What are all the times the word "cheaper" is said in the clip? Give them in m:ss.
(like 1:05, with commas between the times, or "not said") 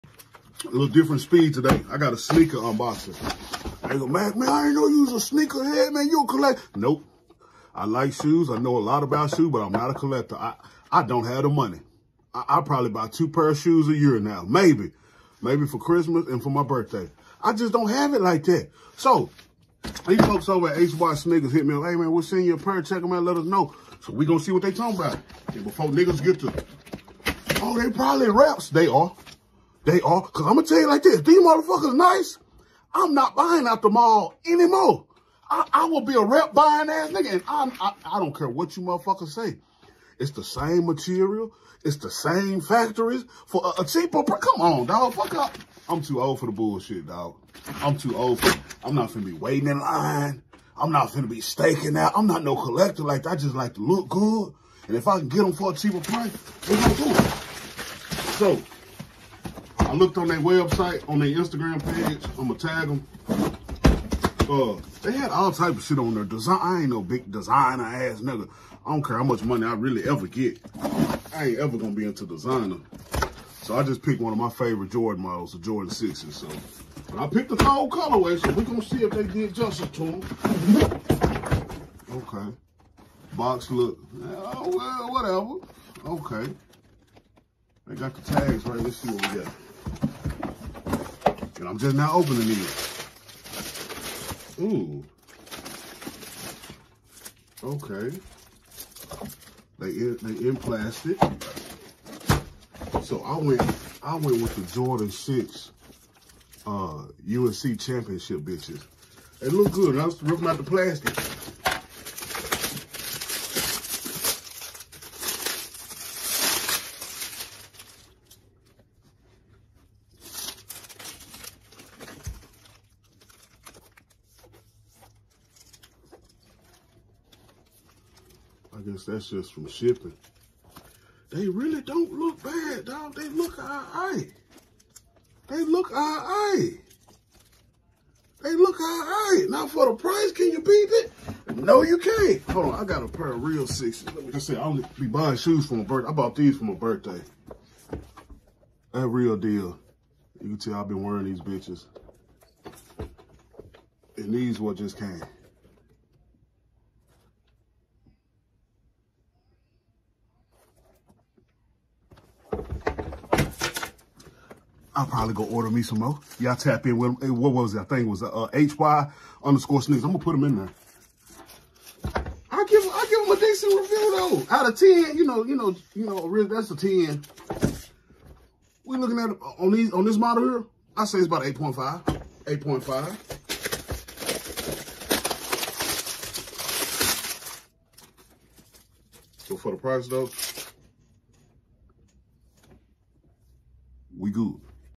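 0:43, 0:55.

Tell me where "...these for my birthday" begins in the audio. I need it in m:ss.
2:26.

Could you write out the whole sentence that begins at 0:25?
before niggas get to, oh, they probably reps.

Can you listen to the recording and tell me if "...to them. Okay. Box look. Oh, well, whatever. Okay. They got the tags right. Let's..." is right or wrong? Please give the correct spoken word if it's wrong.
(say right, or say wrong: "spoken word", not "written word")
right.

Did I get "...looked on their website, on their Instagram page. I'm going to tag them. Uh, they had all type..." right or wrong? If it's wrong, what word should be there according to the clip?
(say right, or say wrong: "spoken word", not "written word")
right.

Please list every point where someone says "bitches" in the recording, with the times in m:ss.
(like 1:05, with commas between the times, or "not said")
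1:48, 2:31.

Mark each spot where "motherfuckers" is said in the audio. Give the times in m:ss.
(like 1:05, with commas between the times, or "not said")
0:31, 0:38.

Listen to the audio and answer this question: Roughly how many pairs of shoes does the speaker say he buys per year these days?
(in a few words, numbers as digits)
2.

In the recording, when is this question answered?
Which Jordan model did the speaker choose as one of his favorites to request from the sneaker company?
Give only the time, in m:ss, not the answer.
1:15.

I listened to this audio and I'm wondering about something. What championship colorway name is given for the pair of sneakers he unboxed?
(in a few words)
USC championship.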